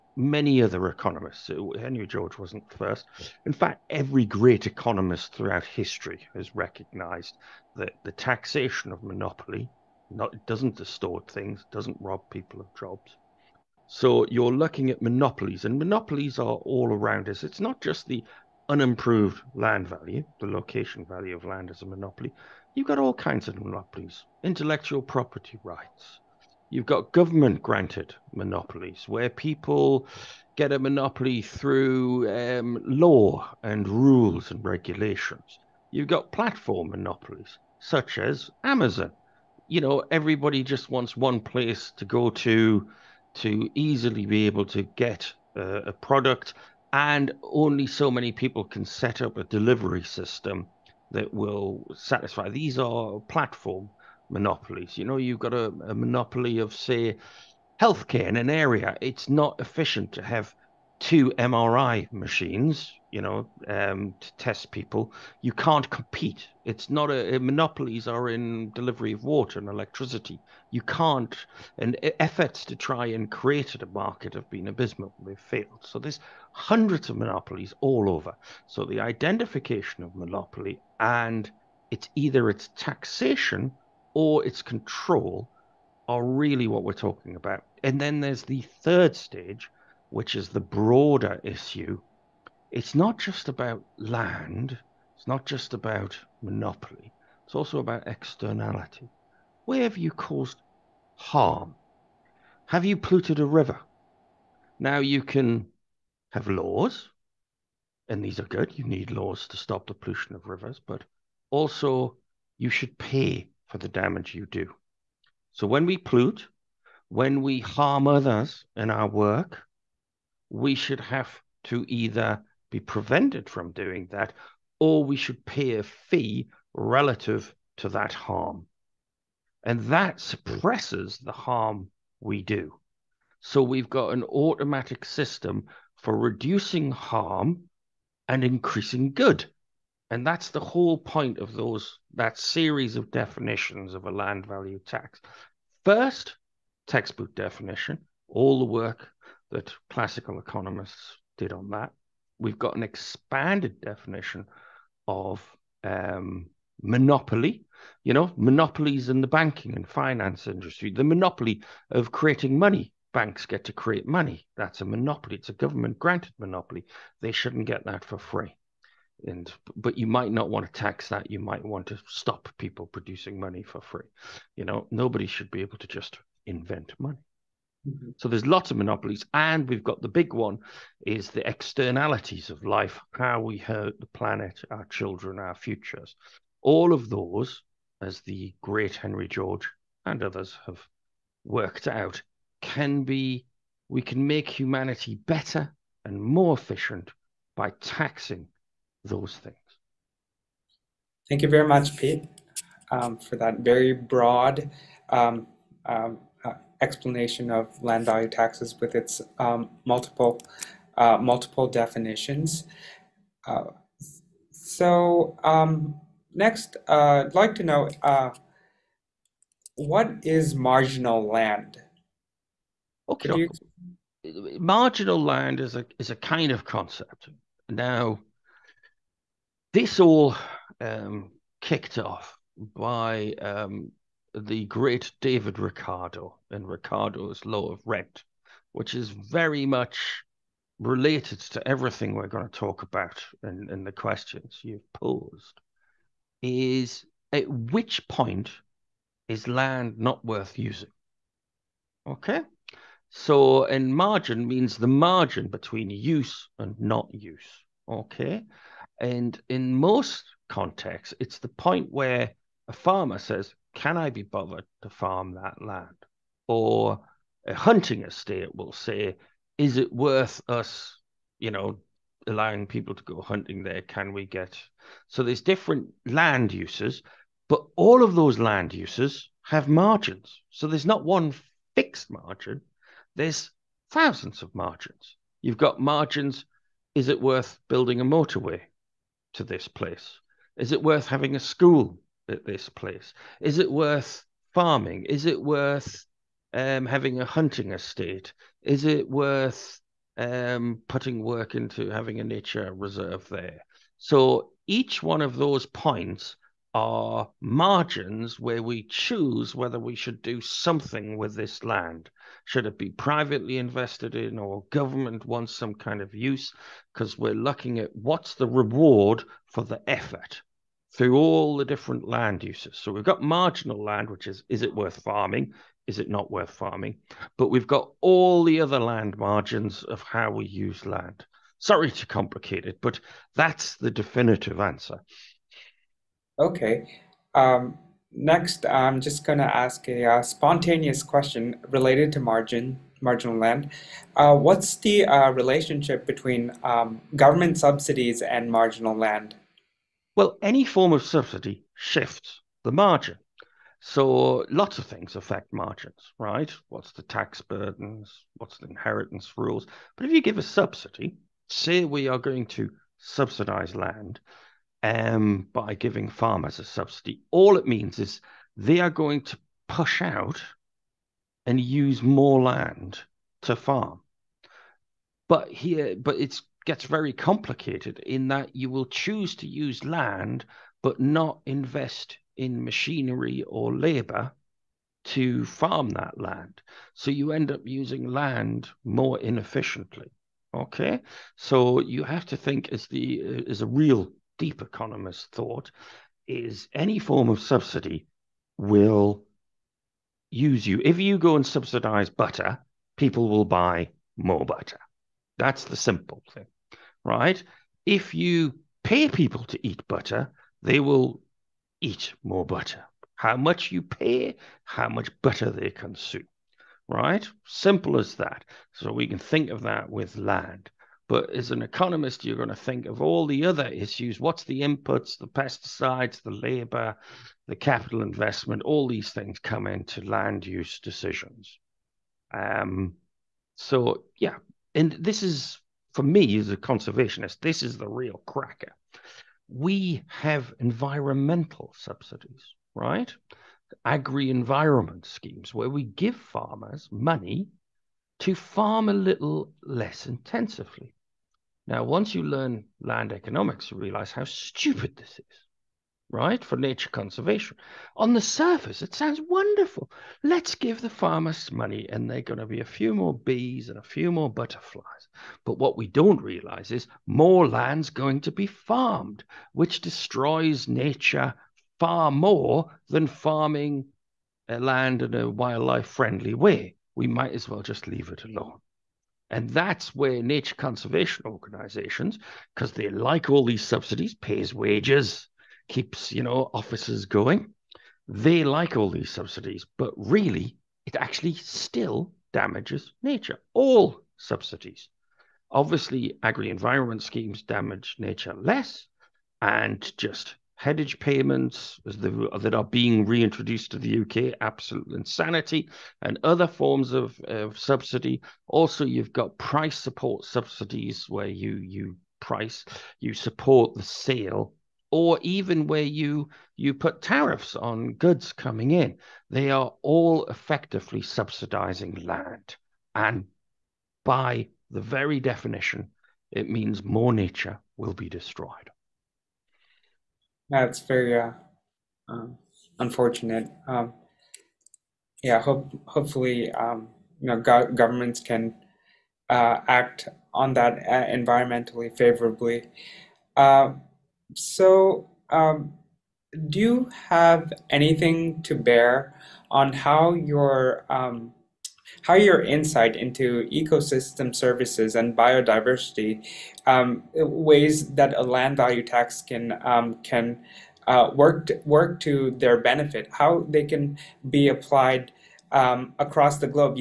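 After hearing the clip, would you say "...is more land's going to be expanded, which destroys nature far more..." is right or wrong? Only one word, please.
wrong.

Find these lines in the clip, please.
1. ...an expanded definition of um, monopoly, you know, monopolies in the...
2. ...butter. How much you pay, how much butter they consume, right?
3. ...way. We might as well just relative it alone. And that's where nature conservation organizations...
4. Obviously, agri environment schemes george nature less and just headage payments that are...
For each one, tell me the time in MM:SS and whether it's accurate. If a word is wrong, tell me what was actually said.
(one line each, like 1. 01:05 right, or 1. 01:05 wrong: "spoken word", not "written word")
1. 02:32 right
2. 06:52 right
3. 07:56 wrong: "leave", not "relative"
4. 08:15 wrong: "damage", not "george".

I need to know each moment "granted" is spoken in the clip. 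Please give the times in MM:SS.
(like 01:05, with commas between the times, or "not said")
00:27, 02:45.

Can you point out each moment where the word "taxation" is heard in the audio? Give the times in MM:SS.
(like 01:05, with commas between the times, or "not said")
00:08, 01:22.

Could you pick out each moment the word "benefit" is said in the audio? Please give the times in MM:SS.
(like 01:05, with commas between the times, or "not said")
09:22.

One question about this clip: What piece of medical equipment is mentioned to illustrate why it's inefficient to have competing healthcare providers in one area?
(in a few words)
MRI machines.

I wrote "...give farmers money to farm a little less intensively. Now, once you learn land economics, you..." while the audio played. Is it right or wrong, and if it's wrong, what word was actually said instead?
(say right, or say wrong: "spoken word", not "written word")
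right.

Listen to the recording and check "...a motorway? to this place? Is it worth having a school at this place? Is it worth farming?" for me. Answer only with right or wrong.
right.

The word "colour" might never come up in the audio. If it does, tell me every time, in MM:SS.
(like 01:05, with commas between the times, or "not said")
not said.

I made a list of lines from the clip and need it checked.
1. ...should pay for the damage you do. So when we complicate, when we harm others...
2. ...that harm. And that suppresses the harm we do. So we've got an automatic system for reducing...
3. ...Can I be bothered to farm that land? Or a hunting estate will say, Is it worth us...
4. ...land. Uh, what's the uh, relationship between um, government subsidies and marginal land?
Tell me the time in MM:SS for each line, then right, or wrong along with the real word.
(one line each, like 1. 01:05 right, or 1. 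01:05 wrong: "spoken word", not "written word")
1. 01:52 wrong: "pollute", not "complicate"
2. 02:07 right
3. 04:23 right
4. 05:43 right.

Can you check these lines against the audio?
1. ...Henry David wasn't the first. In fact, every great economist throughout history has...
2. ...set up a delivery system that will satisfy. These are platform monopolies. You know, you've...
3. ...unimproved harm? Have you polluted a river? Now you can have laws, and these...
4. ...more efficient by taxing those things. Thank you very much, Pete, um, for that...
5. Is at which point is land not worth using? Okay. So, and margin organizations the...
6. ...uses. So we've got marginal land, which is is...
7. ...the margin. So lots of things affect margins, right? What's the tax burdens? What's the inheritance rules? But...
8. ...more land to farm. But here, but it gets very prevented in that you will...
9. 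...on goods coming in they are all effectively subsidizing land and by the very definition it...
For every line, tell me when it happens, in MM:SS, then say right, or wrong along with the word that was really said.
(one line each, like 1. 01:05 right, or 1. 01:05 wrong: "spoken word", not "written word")
1. 00:01 wrong: "George", not "David"
2. 00:48 right
3. 01:40 wrong: "caused", not "unimproved"
4. 03:16 right
5. 04:06 wrong: "means", not "organizations"
6. 05:22 right
7. 05:52 right
8. 06:12 wrong: "complicated", not "prevented"
9. 08:37 right.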